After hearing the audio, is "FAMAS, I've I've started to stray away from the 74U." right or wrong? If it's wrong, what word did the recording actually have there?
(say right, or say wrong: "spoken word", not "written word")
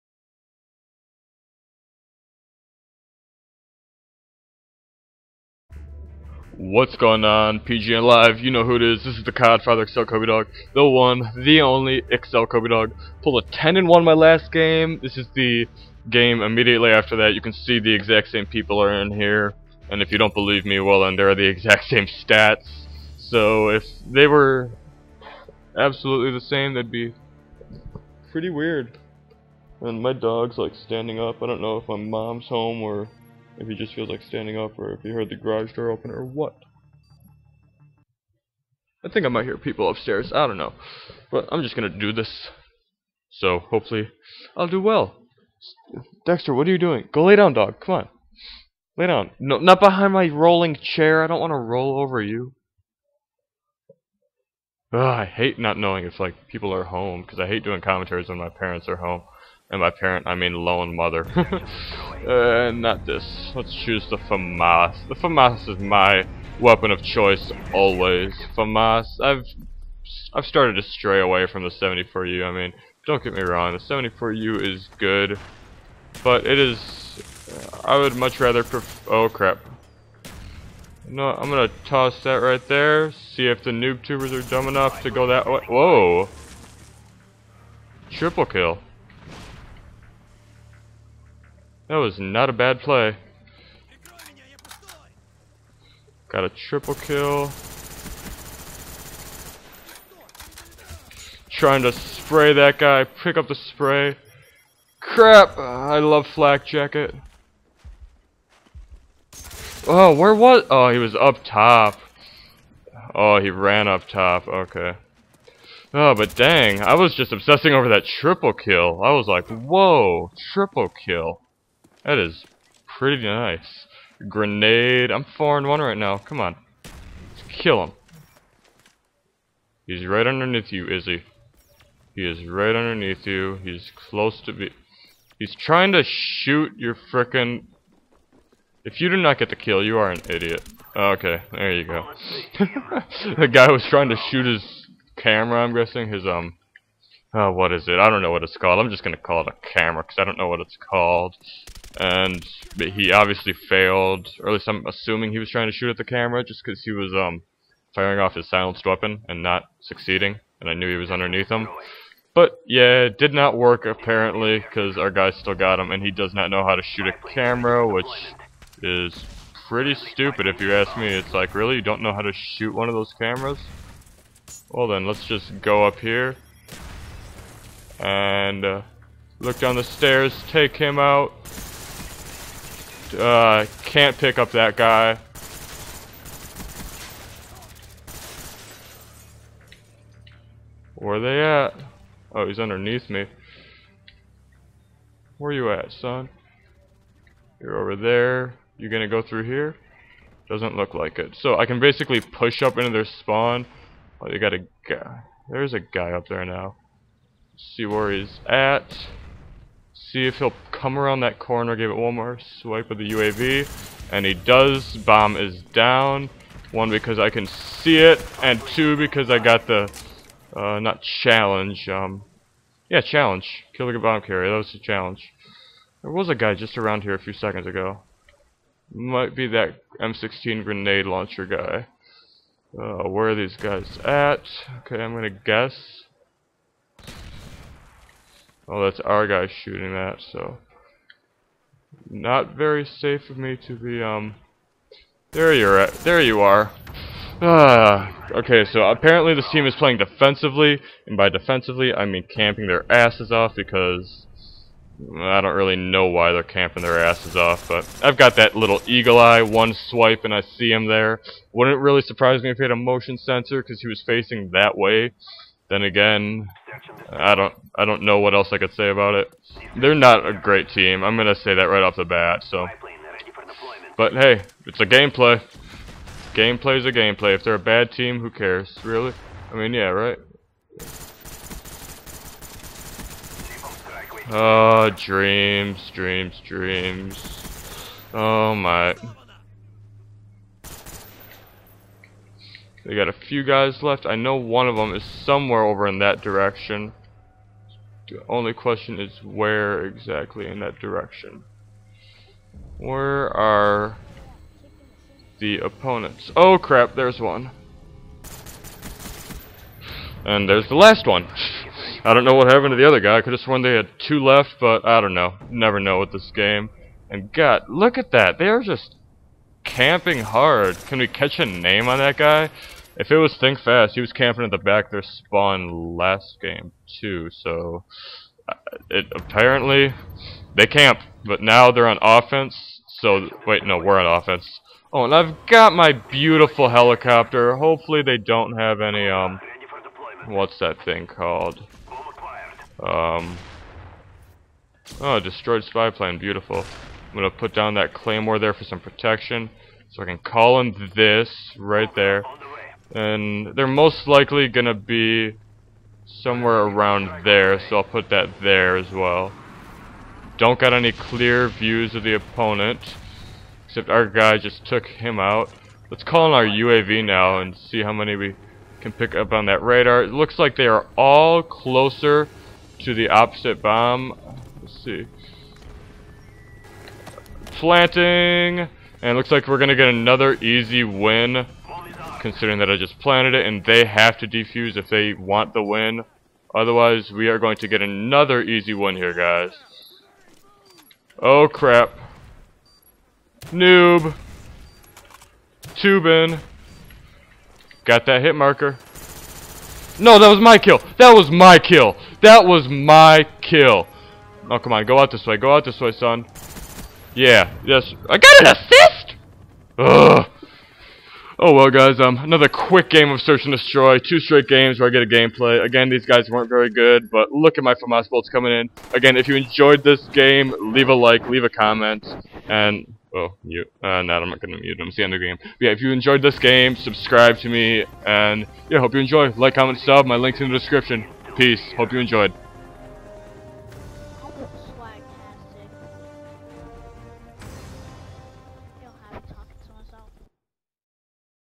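right.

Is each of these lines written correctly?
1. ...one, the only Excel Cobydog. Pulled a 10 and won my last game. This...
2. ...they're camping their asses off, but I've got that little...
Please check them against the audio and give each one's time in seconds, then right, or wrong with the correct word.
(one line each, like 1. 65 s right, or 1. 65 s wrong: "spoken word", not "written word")
1. 10 s right
2. 256 s right.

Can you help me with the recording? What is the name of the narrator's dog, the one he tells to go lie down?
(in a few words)
Dexter.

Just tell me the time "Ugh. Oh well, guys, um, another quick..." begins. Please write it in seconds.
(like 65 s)
409 s.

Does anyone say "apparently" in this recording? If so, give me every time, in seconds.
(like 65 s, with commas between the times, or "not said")
163 s, 248 s, 329 s.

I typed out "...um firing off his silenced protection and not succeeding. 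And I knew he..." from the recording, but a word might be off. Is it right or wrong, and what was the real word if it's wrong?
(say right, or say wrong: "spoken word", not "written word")
wrong: "weapon", not "protection".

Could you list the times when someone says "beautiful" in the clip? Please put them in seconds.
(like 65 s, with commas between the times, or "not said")
335 s, 346 s.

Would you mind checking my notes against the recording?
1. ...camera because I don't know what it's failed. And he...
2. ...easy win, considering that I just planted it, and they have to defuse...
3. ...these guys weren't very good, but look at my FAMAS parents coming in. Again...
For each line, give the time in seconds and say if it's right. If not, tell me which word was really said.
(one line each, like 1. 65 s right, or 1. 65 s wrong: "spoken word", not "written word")
1. 149 s wrong: "called", not "failed"
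2. 380 s right
3. 415 s wrong: "bolts", not "parents".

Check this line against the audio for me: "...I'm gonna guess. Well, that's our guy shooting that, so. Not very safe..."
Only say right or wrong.
right.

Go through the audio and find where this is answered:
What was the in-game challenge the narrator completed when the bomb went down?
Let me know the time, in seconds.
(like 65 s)
223 s.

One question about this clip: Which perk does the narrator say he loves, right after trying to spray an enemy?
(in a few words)
Flak jacket.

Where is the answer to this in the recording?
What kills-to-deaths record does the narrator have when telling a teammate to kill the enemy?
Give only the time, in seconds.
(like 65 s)
125 s.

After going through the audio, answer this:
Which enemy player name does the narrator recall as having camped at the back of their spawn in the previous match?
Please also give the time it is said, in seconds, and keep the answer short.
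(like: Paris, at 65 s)
Think Fast, at 323 s.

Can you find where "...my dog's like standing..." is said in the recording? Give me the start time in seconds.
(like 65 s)
30 s.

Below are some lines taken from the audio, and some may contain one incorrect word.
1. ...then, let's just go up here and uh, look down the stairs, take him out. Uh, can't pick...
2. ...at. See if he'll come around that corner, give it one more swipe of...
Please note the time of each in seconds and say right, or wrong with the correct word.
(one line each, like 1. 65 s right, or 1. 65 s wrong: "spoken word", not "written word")
1. 174 s right
2. 208 s right.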